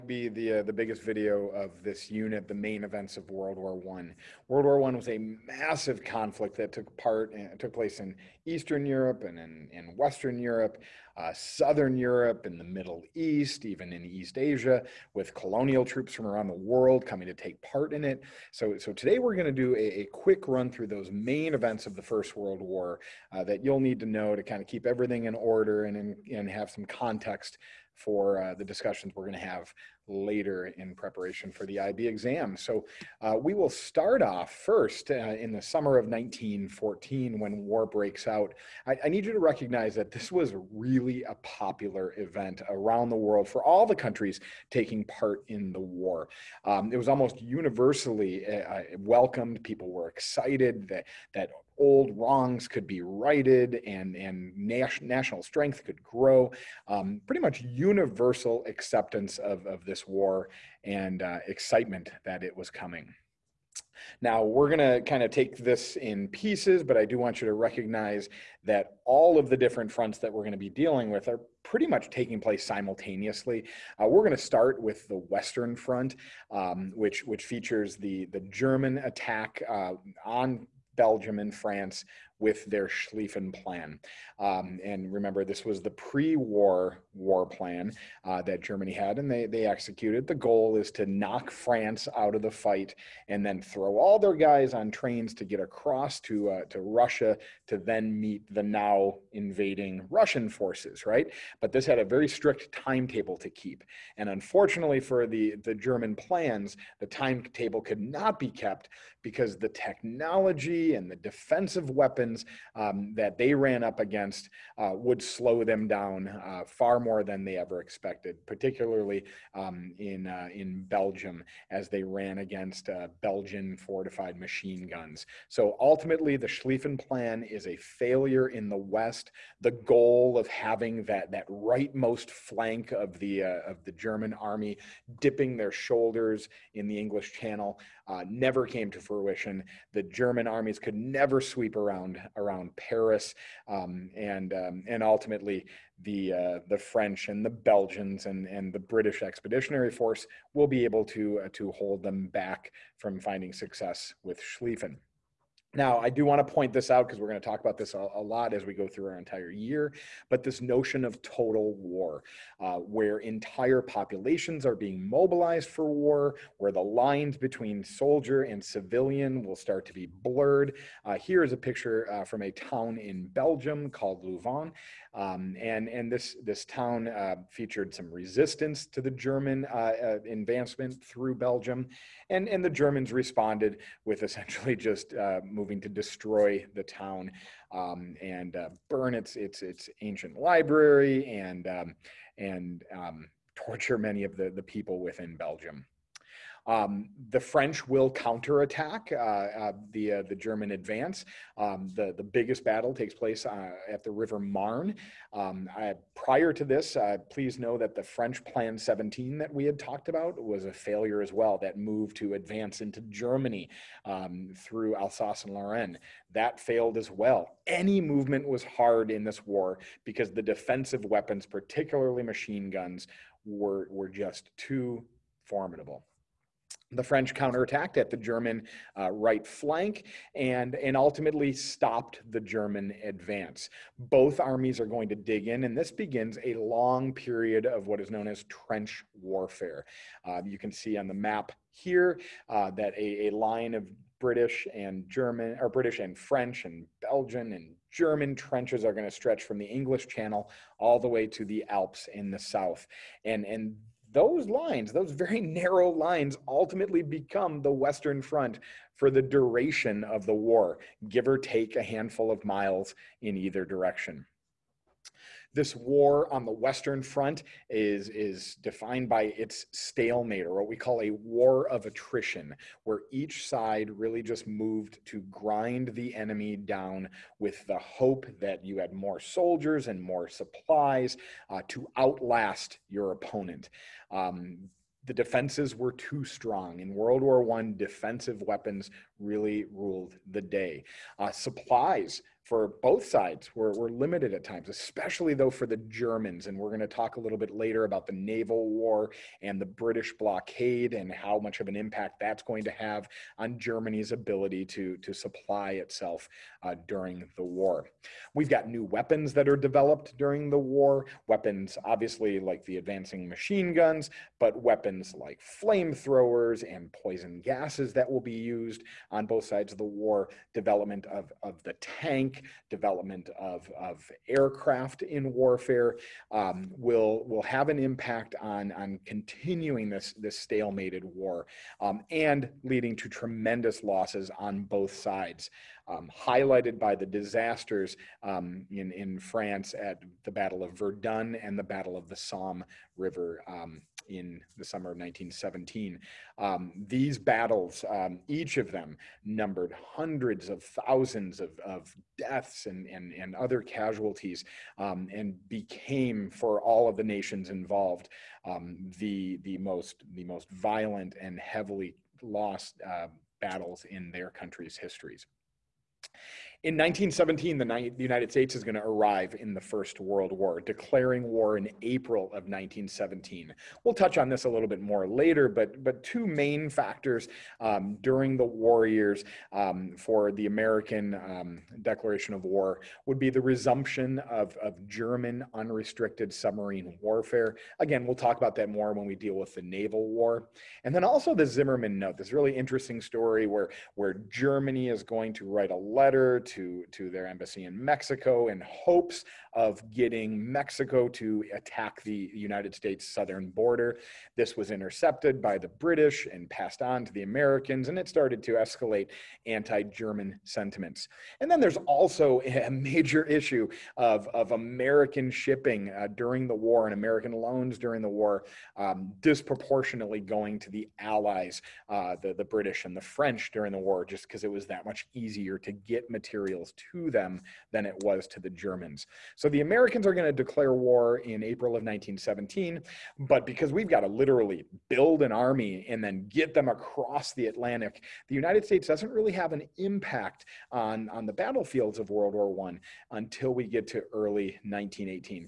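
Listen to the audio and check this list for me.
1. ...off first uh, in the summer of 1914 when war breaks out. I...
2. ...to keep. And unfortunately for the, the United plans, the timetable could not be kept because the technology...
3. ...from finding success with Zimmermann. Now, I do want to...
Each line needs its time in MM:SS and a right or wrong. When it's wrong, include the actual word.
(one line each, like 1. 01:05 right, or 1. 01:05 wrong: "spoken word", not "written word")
1. 00:34 right
2. 01:43 wrong: "German", not "United"
3. 02:32 wrong: "Schlieffen", not "Zimmermann".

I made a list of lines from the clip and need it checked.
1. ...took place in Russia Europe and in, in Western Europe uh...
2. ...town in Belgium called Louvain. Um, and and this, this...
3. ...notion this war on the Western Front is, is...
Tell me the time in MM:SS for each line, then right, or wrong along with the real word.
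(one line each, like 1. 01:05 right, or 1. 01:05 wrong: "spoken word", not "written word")
1. 00:07 wrong: "Eastern", not "Russia"
2. 02:52 right
3. 04:23 wrong: "direction", not "notion".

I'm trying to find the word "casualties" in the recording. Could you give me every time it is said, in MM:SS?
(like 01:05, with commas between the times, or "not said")
05:53.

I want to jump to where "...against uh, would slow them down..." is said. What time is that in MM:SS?
01:53.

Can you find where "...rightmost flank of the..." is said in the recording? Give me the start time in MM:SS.
02:11.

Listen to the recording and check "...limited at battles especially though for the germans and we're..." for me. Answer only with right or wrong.
wrong.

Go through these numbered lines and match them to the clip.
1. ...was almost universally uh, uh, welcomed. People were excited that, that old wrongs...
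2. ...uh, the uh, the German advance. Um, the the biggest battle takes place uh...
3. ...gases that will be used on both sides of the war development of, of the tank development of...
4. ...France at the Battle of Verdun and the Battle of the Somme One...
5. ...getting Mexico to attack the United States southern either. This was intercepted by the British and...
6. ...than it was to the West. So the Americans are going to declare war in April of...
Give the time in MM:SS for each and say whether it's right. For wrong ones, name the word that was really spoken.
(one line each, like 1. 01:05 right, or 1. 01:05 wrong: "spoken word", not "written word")
1. 00:46 right
2. 03:19 right
3. 05:17 right
4. 05:39 wrong: "River", not "One"
5. 06:39 wrong: "border", not "either"
6. 07:07 wrong: "Germans", not "West".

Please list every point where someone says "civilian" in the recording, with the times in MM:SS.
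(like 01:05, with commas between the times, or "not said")
02:48.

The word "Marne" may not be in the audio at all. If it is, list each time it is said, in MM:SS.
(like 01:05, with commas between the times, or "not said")
03:24.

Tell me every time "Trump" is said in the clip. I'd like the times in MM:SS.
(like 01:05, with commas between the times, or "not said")
not said.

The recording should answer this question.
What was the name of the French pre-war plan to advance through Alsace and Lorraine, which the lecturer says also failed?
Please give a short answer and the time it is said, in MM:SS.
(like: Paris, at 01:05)
Plan 17, at 03:28.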